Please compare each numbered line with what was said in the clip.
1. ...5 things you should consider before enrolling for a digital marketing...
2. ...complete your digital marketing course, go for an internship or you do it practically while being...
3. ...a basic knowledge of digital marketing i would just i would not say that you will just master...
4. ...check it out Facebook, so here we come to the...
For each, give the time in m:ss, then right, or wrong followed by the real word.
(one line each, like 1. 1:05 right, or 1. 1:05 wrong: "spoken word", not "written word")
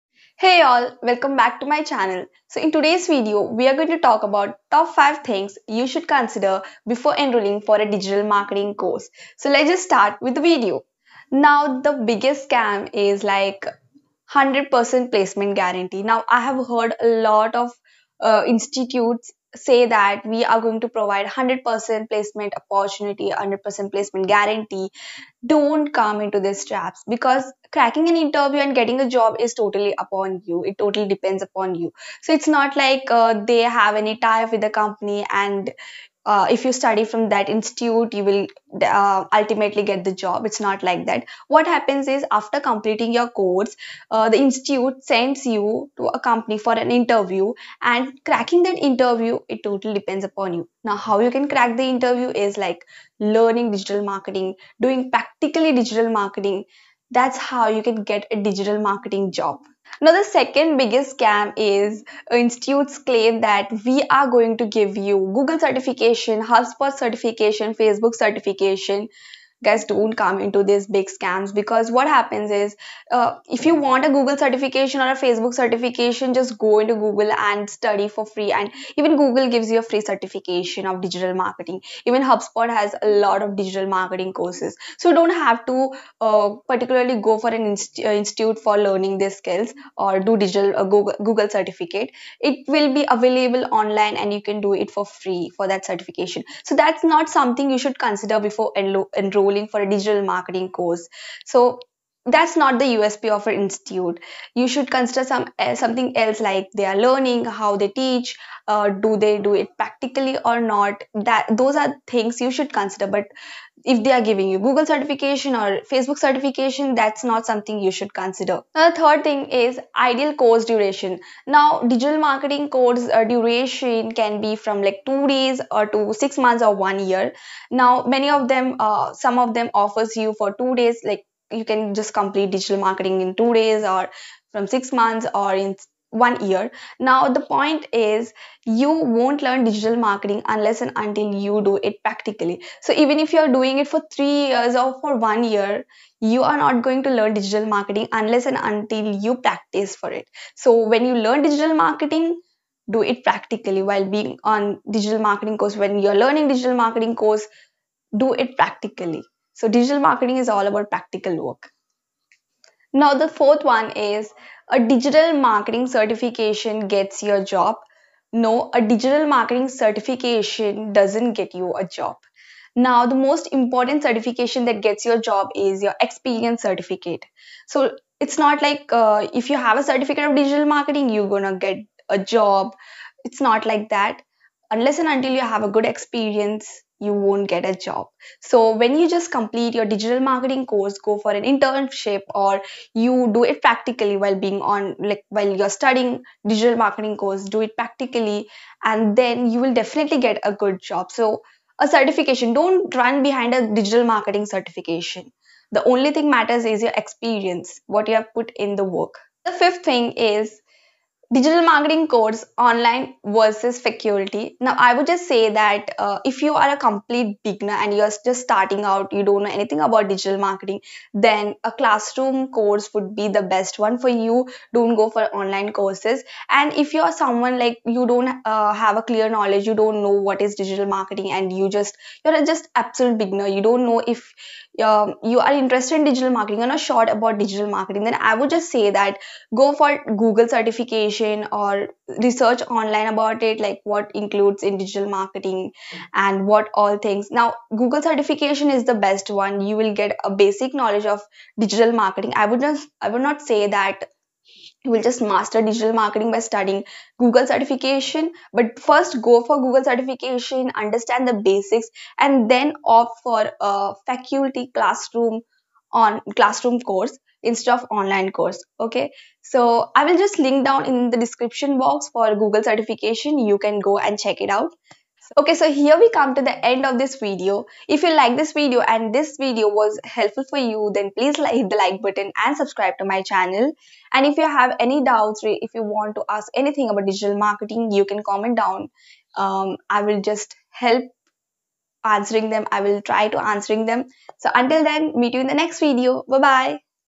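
1. 0:04 right
2. 3:09 right
3. 4:10 right
4. 4:34 wrong: "Okay", not "Facebook".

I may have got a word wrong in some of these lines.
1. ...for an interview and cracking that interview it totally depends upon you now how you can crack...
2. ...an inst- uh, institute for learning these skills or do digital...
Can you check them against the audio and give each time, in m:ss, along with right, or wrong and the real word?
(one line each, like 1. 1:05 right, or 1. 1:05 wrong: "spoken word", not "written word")
1. 0:46 right
2. 1:27 right.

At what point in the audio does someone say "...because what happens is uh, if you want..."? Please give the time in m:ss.
1:11.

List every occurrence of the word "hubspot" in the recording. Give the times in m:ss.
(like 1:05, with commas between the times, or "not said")
1:06, 1:22.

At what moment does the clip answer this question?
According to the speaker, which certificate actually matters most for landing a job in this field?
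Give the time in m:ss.
2:56.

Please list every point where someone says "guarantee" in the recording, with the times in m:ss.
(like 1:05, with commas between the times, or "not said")
0:15, 0:24.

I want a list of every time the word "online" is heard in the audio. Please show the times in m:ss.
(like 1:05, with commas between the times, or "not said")
1:33, 3:32, 3:45, 4:02, 4:27.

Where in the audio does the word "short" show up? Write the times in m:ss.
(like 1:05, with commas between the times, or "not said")
3:56.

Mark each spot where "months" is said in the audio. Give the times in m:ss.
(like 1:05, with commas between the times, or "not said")
2:06, 2:14.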